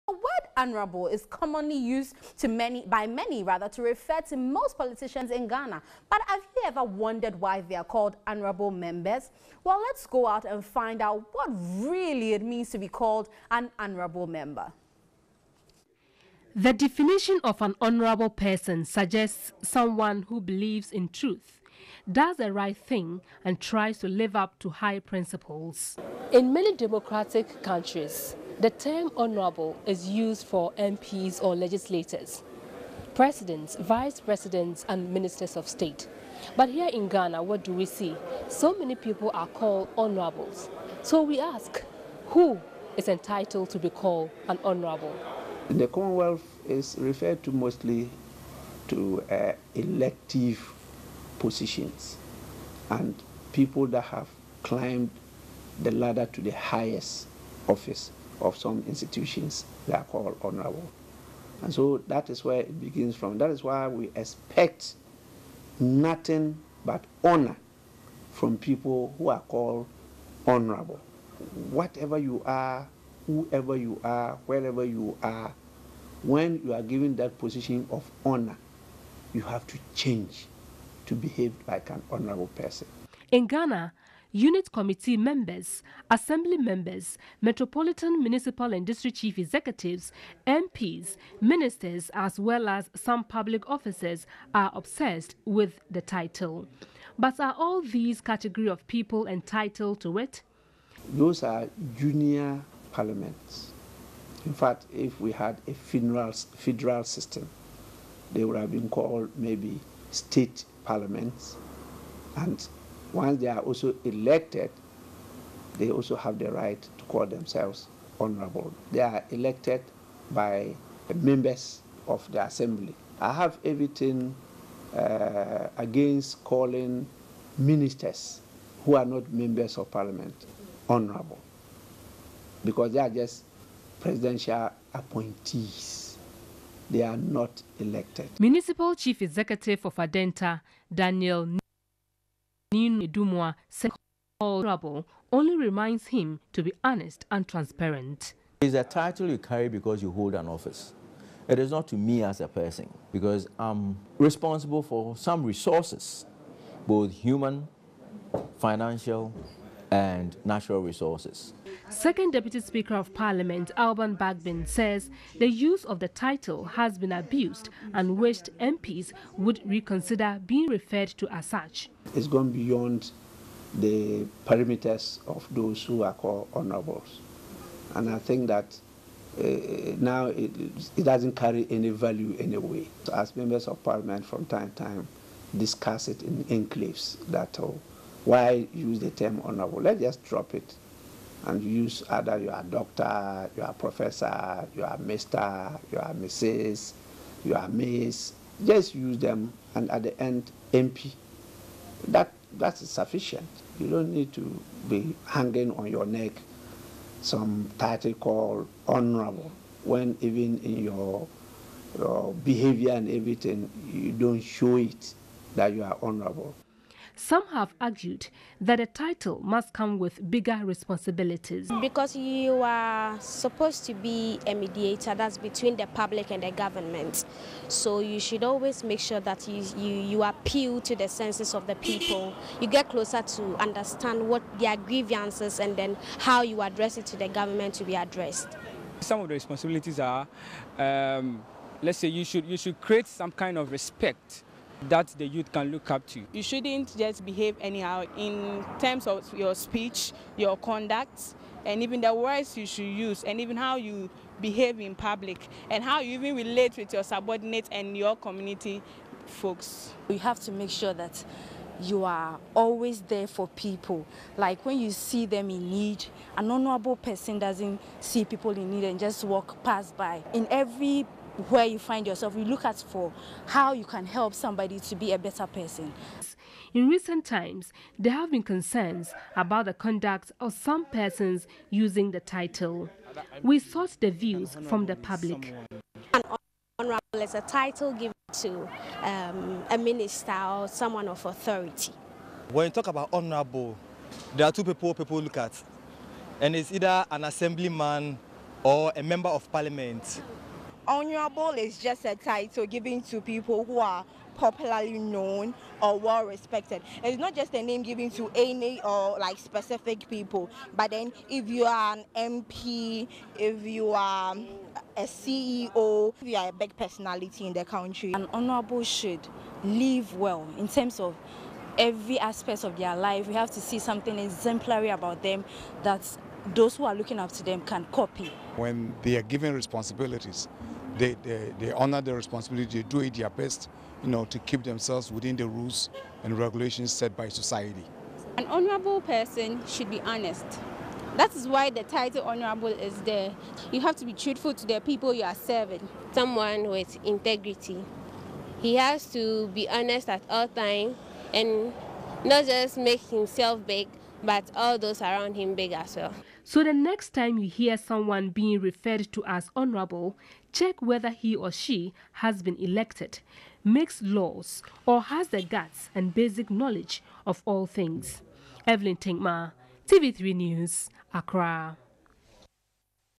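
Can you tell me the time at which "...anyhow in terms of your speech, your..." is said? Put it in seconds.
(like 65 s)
247 s.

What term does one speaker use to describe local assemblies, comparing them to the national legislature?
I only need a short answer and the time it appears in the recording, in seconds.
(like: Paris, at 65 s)
junior parliaments, at 101 s.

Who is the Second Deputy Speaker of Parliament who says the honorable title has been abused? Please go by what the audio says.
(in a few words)
Alban Bagbin.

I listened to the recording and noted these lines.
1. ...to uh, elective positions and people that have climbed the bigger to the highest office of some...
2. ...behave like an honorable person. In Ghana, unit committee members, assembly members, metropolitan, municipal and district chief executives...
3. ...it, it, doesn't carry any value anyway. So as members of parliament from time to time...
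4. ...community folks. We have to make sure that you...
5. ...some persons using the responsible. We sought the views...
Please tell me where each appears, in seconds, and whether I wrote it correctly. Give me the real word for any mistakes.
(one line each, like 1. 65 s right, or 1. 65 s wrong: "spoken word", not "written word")
1. 48 s wrong: "ladder", not "bigger"
2. 81 s right
3. 180 s right
4. 258 s right
5. 280 s wrong: "title", not "responsible".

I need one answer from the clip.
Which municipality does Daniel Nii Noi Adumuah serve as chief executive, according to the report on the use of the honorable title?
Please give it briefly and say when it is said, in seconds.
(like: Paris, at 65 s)
Adenta, at 139 s.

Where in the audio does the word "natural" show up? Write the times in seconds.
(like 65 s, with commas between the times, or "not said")
160 s.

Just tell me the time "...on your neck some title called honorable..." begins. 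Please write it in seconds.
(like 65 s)
205 s.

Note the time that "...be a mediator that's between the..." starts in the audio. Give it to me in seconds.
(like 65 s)
223 s.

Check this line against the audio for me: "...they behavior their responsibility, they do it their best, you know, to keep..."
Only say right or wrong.
wrong.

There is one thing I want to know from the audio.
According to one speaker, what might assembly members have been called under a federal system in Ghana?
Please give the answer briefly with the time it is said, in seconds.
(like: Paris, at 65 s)
state parliaments, at 110 s.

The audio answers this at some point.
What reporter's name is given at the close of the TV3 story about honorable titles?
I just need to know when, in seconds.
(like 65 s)
368 s.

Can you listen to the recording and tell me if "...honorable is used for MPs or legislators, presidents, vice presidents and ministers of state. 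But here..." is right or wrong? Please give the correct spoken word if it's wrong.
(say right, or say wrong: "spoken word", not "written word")
right.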